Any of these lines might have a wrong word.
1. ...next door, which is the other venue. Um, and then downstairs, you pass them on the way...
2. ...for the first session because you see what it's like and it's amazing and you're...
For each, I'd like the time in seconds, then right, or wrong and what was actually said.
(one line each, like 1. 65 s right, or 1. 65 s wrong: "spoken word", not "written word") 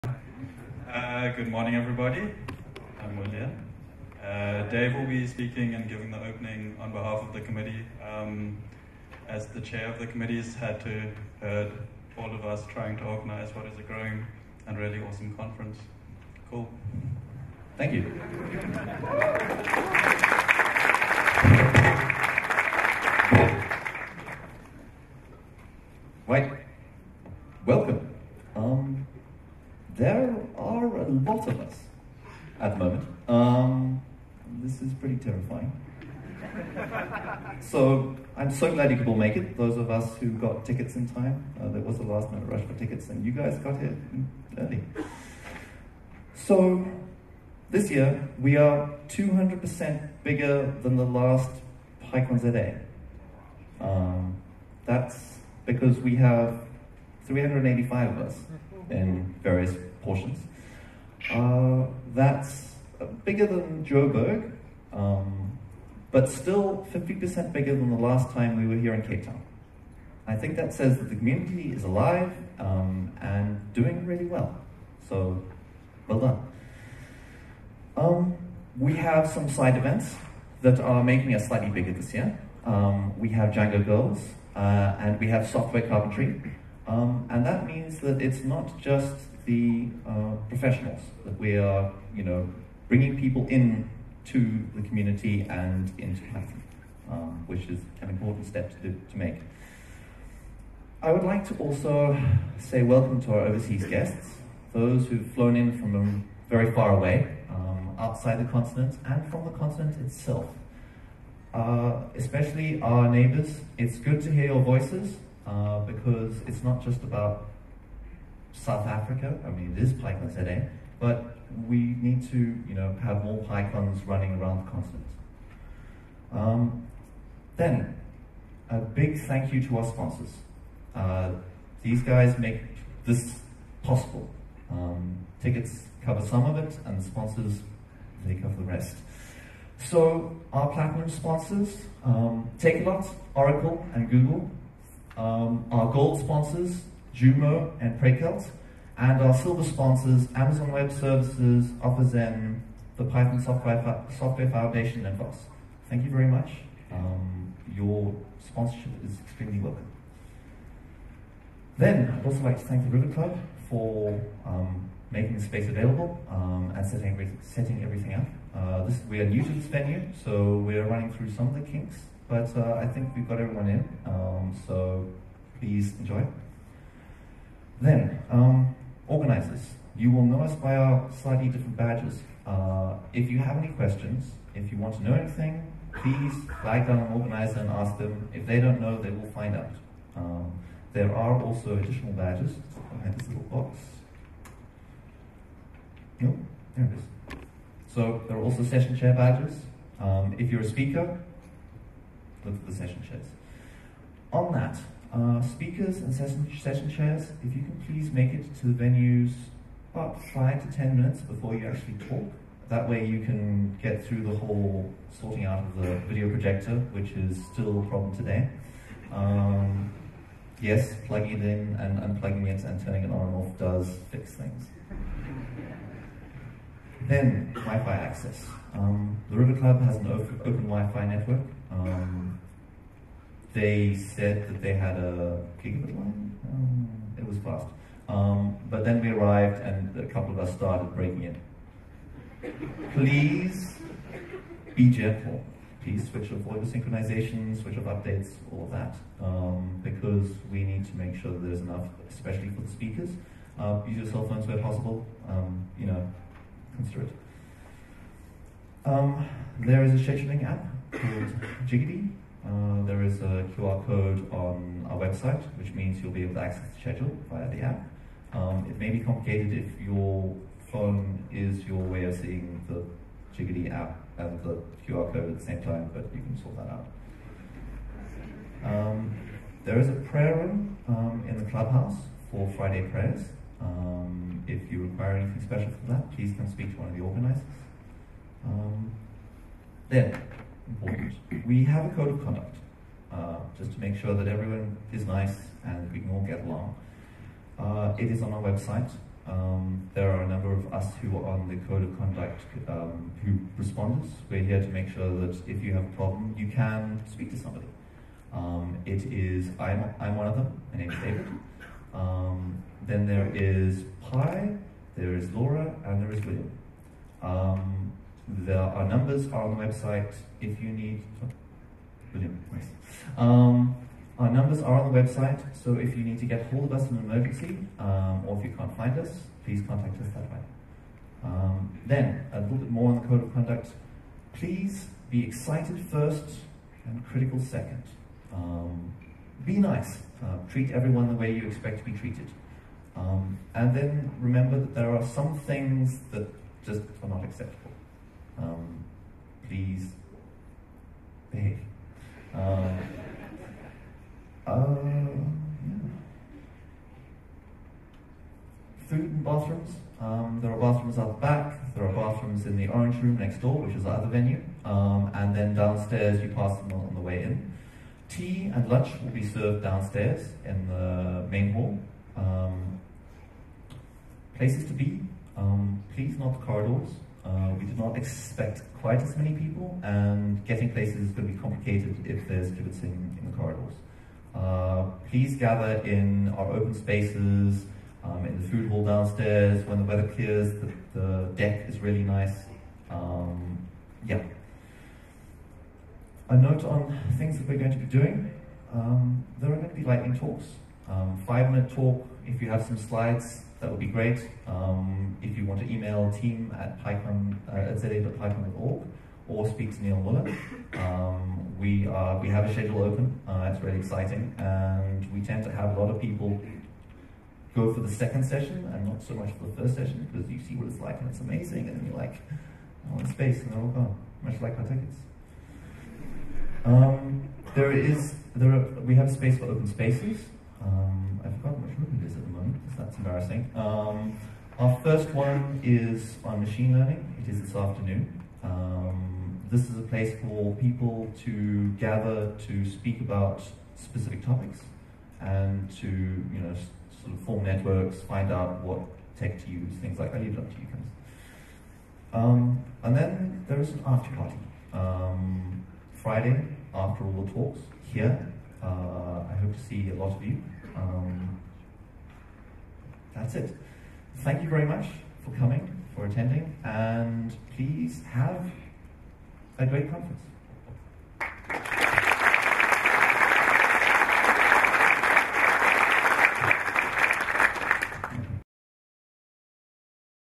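1. 363 s right
2. 419 s right.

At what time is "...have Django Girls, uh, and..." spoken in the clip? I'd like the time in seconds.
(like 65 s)
83 s.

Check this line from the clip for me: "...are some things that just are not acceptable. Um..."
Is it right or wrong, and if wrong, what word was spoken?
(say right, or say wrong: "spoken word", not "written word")
right.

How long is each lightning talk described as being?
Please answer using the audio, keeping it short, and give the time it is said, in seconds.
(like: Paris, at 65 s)
5 minutes, at 401 s.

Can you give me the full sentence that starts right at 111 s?
Uh, especially our neighbors, it's good to hear your voices uh, because it's not just about South Africa.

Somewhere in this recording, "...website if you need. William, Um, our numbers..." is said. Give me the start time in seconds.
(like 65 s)
319 s.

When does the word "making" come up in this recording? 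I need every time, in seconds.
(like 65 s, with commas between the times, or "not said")
81 s, 165 s.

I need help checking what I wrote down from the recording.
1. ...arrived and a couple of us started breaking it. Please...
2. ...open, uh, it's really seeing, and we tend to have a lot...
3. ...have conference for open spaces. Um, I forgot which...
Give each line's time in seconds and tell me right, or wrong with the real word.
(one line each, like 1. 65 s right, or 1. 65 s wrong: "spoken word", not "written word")
1. 239 s right
2. 412 s wrong: "exciting", not "seeing"
3. 428 s wrong: "space", not "conference".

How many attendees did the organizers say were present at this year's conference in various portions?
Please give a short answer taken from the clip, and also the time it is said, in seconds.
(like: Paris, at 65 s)
385, at 57 s.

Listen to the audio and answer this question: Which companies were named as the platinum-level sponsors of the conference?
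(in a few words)
Takealot, Oracle, and Google.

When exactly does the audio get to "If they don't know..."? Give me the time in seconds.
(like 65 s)
188 s.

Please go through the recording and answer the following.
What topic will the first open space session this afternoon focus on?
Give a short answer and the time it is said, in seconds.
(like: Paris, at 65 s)
Machine learning, at 436 s.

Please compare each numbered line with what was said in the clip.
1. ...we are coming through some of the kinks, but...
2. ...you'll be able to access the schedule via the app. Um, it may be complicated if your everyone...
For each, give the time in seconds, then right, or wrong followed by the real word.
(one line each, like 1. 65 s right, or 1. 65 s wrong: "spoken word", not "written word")
1. 170 s wrong: "running", not "coming"
2. 266 s wrong: "phone", not "everyone".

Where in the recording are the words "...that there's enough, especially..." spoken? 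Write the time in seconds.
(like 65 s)
251 s.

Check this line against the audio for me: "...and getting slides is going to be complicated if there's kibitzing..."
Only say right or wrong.
wrong.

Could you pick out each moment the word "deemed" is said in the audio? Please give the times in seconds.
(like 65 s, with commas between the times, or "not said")
not said.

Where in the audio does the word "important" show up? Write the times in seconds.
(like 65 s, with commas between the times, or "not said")
98 s, 290 s.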